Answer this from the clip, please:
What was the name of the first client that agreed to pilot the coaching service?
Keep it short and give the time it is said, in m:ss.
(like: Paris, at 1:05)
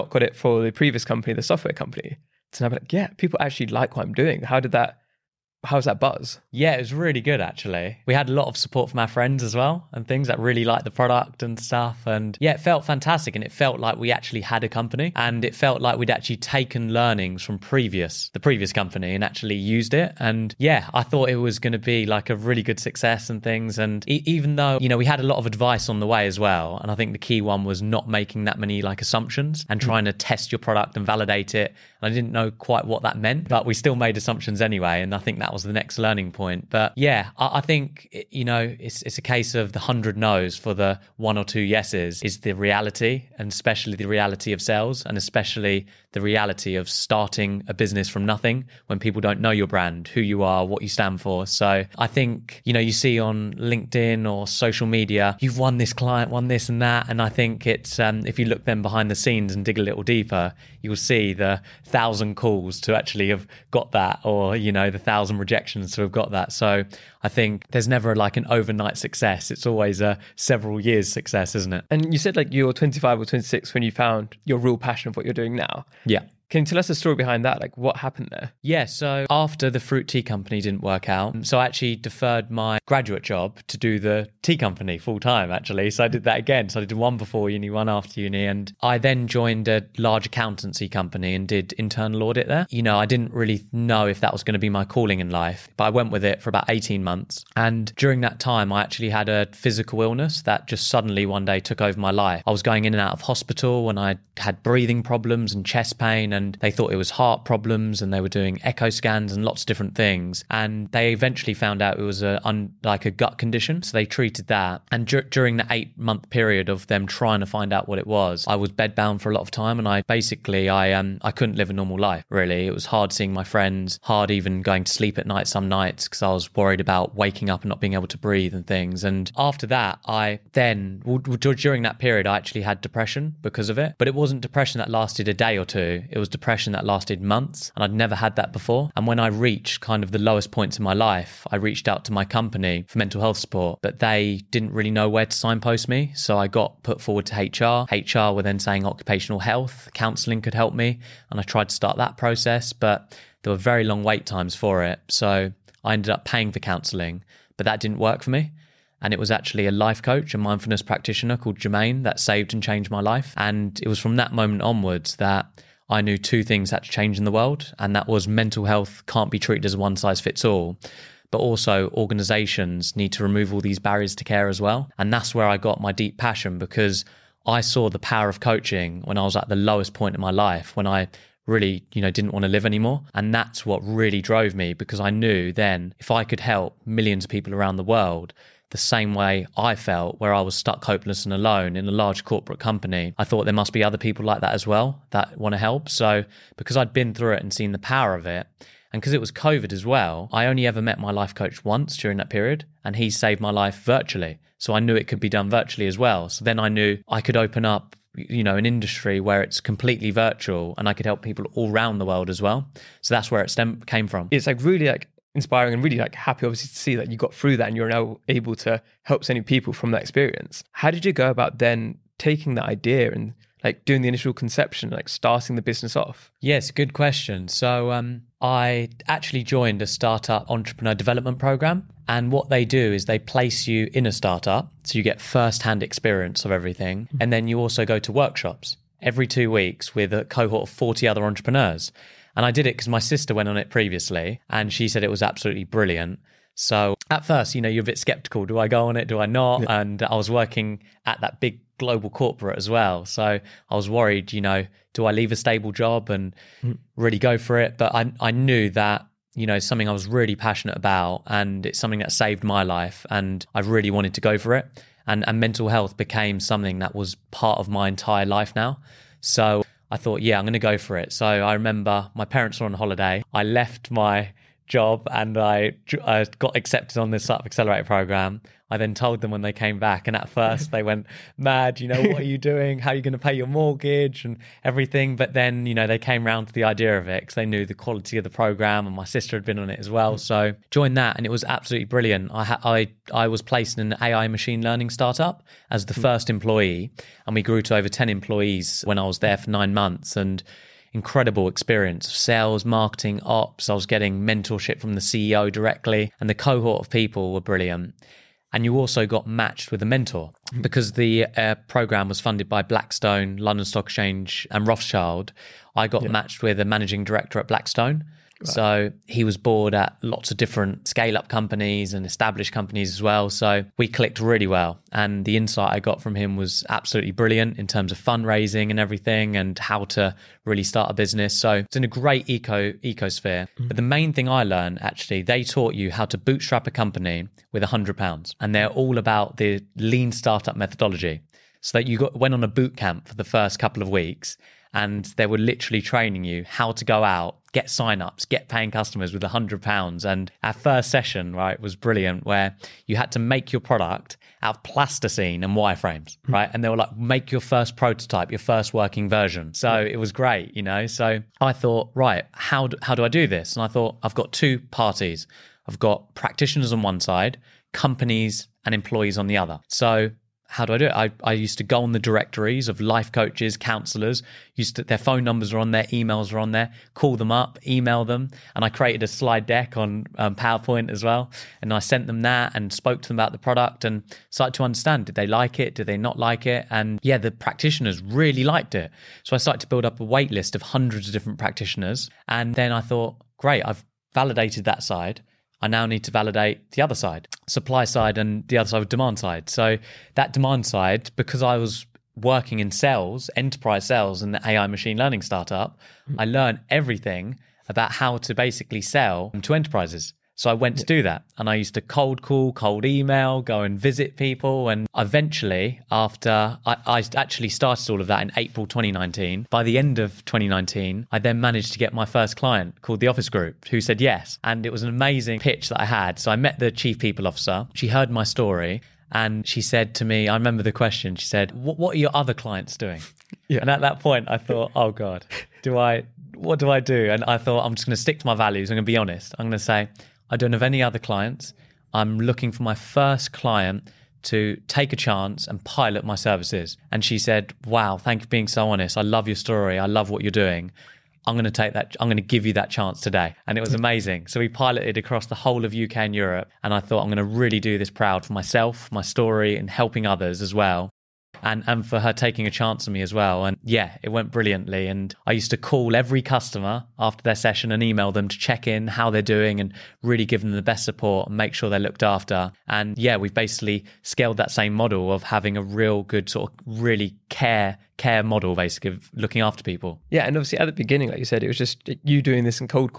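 The Office Group, at 7:03.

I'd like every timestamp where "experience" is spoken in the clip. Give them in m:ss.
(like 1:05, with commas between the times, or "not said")
3:40, 3:55, 5:01.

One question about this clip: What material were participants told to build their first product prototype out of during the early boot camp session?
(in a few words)
Plasticine.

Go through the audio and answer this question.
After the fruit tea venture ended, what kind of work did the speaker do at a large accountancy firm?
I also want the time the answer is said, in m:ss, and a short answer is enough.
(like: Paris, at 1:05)
Internal audit, at 1:31.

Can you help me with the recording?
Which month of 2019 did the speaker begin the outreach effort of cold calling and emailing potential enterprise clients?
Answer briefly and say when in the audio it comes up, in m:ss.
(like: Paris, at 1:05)
April, at 6:58.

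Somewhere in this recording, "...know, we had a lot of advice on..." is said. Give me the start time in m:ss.
0:24.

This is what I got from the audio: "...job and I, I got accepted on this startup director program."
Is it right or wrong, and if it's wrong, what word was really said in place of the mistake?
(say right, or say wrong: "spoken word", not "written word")
wrong: "accelerator", not "director".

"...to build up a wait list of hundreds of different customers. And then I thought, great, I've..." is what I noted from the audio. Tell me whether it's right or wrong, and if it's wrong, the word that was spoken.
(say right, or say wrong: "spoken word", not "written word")
wrong: "practitioners", not "customers".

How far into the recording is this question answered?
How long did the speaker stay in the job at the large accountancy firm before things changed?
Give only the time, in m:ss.
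1:36.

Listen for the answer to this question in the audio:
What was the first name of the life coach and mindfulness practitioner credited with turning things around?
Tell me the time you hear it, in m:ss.
2:41.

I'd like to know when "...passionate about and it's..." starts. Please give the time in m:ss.
4:20.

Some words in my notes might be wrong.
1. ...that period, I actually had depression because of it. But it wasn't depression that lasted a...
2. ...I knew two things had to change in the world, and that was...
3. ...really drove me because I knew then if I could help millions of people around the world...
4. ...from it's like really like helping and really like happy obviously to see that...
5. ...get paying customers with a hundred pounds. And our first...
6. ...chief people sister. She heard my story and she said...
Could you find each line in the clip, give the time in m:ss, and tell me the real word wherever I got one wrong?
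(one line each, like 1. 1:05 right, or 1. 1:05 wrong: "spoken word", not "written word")
1. 2:11 right
2. 2:45 right
3. 3:03 right
4. 3:34 wrong: "inspiring", not "helping"
5. 5:48 right
6. 7:06 wrong: "officer", not "sister".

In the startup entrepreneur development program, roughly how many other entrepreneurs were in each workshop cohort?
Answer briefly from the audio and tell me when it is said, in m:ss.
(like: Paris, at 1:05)
40, at 4:00.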